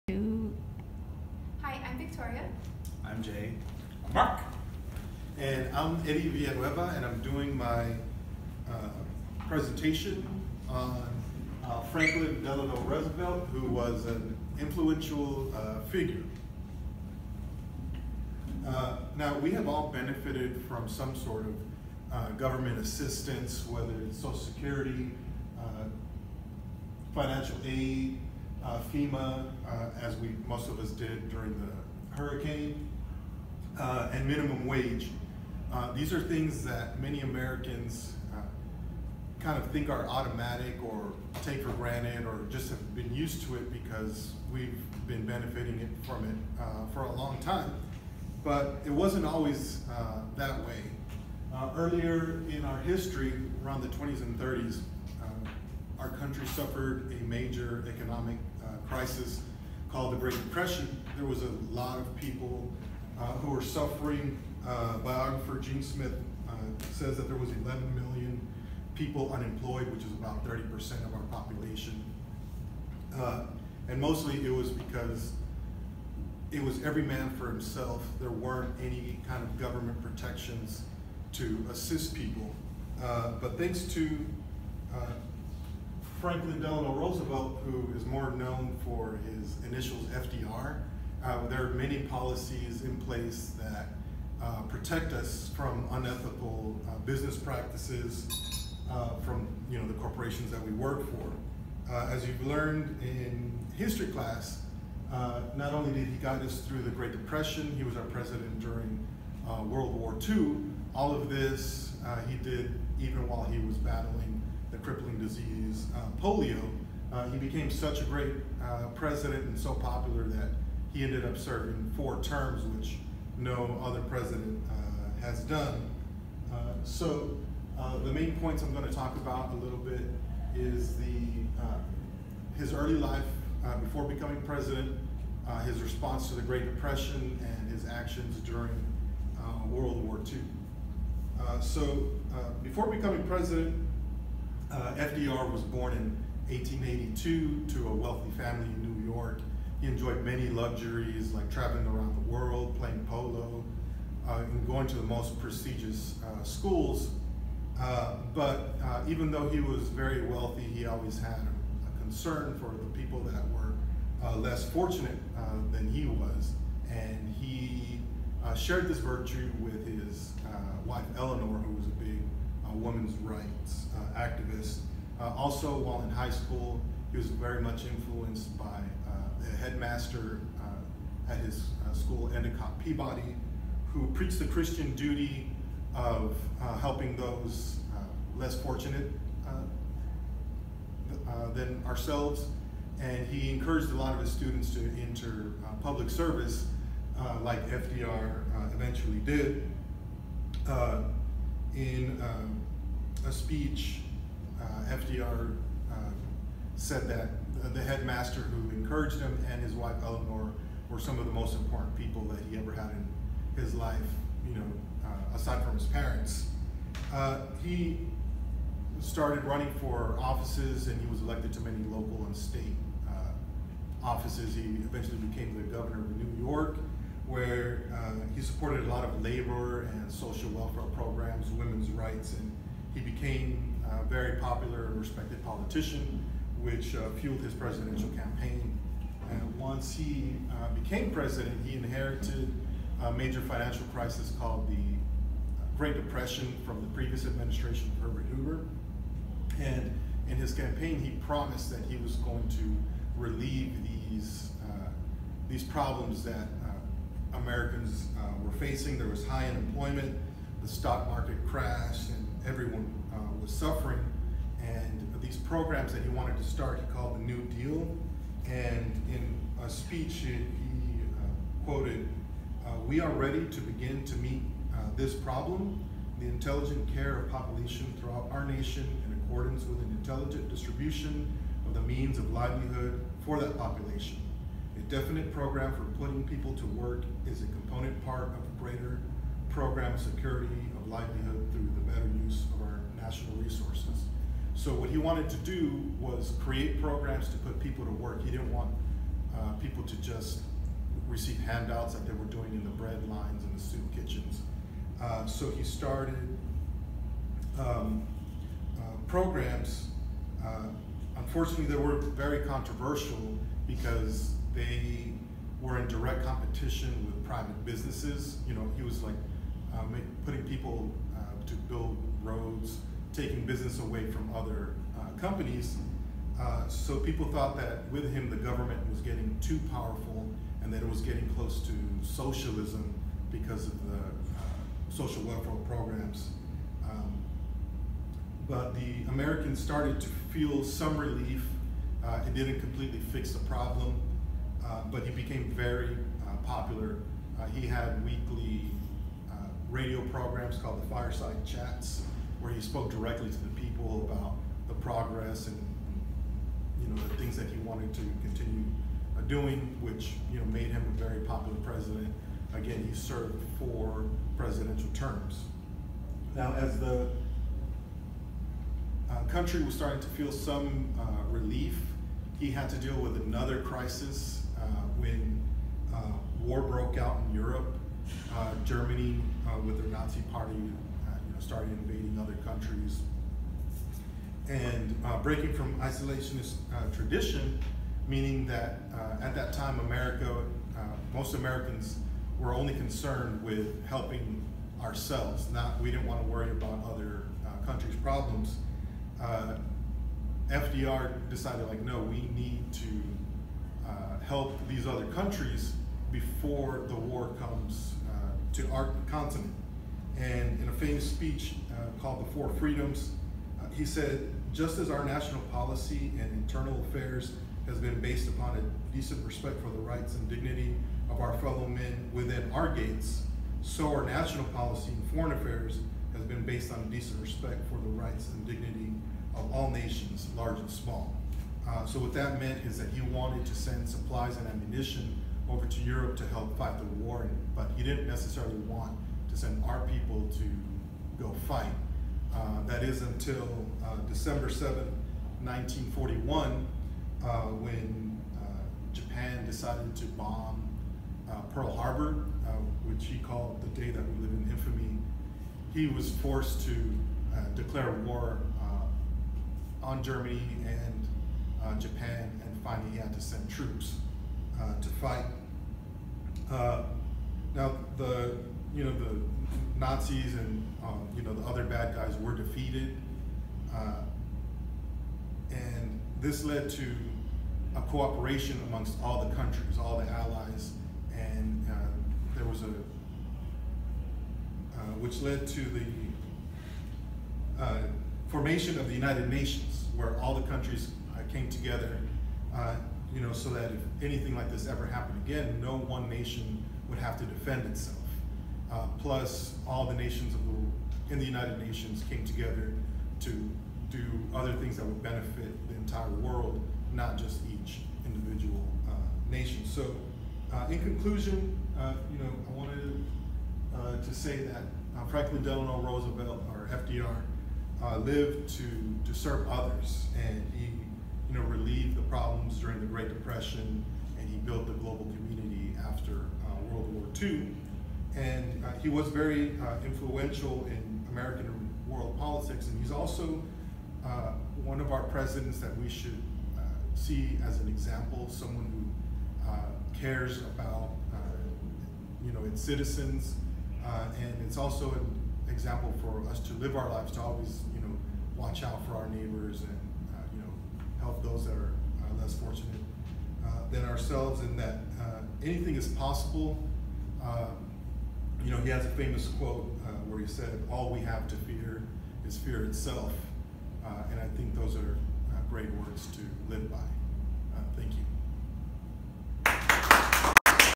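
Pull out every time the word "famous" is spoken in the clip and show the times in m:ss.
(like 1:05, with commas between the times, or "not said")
6:50, 9:18.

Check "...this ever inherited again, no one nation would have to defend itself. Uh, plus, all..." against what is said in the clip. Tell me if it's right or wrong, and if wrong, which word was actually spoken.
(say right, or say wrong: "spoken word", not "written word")
wrong: "happened", not "inherited".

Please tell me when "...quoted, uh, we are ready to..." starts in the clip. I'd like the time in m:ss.
4:31.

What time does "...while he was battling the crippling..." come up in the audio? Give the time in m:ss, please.
1:53.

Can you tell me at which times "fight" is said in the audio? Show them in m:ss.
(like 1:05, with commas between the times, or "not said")
7:16, 7:21, 7:45.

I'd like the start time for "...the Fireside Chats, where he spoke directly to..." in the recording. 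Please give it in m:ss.
5:50.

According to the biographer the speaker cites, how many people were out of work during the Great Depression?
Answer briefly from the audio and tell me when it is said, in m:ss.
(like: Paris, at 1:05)
11 million, at 1:07.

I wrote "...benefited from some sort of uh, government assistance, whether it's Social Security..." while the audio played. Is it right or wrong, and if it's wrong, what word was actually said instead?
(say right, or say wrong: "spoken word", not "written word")
right.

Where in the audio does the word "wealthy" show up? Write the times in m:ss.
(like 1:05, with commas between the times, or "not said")
2:27, 2:40.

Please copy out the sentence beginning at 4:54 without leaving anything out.
So what he wanted to do was create programs to put people to work.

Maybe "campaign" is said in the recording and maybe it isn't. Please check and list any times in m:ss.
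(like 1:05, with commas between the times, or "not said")
3:58, 4:10.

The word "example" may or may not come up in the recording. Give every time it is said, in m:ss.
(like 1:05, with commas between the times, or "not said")
8:57, 9:05.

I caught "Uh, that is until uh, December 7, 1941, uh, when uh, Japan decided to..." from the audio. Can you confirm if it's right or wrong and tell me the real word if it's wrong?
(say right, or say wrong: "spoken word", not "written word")
right.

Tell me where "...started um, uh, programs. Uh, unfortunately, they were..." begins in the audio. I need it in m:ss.
5:05.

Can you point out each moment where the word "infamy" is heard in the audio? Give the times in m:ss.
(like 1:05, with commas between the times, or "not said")
7:34.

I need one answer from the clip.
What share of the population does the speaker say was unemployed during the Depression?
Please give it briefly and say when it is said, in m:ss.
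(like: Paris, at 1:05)
30%, at 1:10.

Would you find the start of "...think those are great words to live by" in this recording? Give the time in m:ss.
9:24.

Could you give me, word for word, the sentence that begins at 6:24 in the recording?
And uh, breaking from isolationist uh, tradition, meaning that uh, at that time, America, most Americans were only concerned with helping ourselves.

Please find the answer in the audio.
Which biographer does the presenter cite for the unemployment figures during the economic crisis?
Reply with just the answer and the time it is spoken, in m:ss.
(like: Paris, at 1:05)
Gene Smith, at 1:05.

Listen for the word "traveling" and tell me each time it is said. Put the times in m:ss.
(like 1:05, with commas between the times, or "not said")
2:31.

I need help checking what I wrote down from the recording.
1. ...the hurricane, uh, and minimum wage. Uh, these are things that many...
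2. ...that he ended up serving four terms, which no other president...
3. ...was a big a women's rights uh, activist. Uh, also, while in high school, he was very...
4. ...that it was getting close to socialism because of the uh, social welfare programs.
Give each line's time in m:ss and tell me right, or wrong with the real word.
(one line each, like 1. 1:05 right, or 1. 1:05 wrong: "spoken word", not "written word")
1. 0:31 right
2. 2:00 right
3. 2:51 right
4. 5:30 right.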